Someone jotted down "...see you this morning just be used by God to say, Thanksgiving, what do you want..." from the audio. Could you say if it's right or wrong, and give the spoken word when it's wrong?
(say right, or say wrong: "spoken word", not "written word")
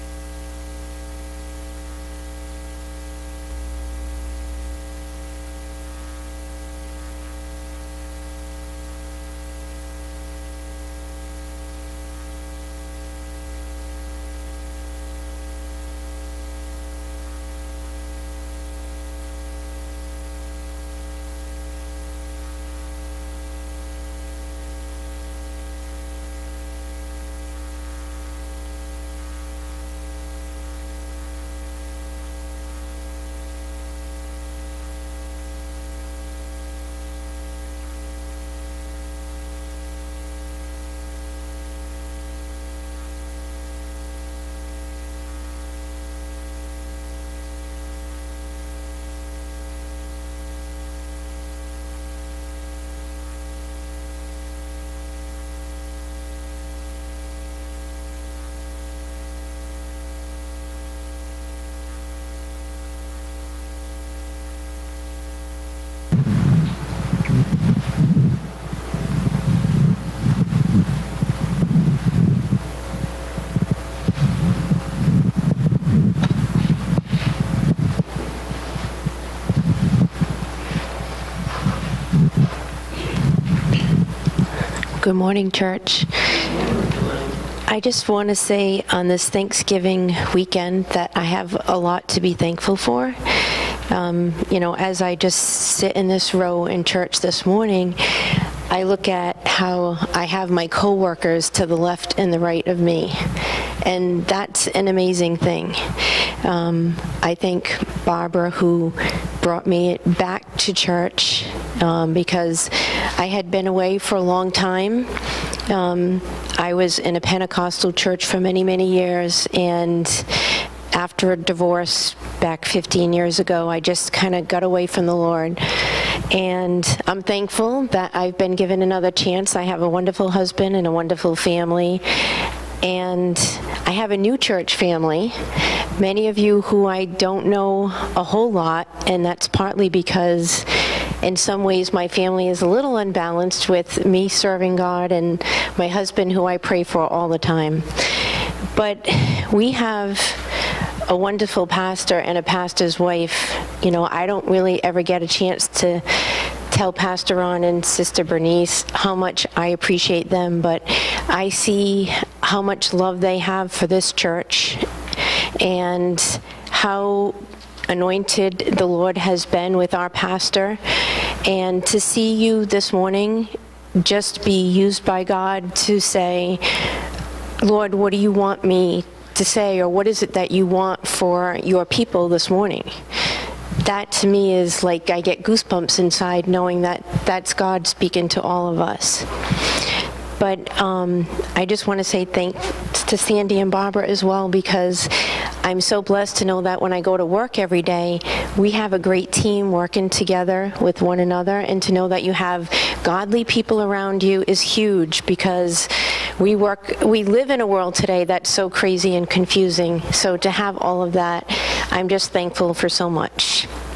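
wrong: "Lord", not "Thanksgiving".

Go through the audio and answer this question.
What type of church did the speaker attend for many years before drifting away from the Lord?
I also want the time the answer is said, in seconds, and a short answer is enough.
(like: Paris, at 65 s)
Pentecostal, at 117 s.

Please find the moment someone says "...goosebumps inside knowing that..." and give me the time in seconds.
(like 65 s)
185 s.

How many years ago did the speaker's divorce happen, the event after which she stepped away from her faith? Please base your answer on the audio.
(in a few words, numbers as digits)
15.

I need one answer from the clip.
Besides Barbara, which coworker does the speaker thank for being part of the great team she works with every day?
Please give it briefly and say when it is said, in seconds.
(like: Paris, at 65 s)
Sandy, at 193 s.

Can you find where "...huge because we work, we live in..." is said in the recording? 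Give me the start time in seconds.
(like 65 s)
204 s.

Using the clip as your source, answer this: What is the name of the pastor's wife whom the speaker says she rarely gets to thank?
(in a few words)
Bernice.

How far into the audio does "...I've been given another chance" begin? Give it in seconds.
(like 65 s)
128 s.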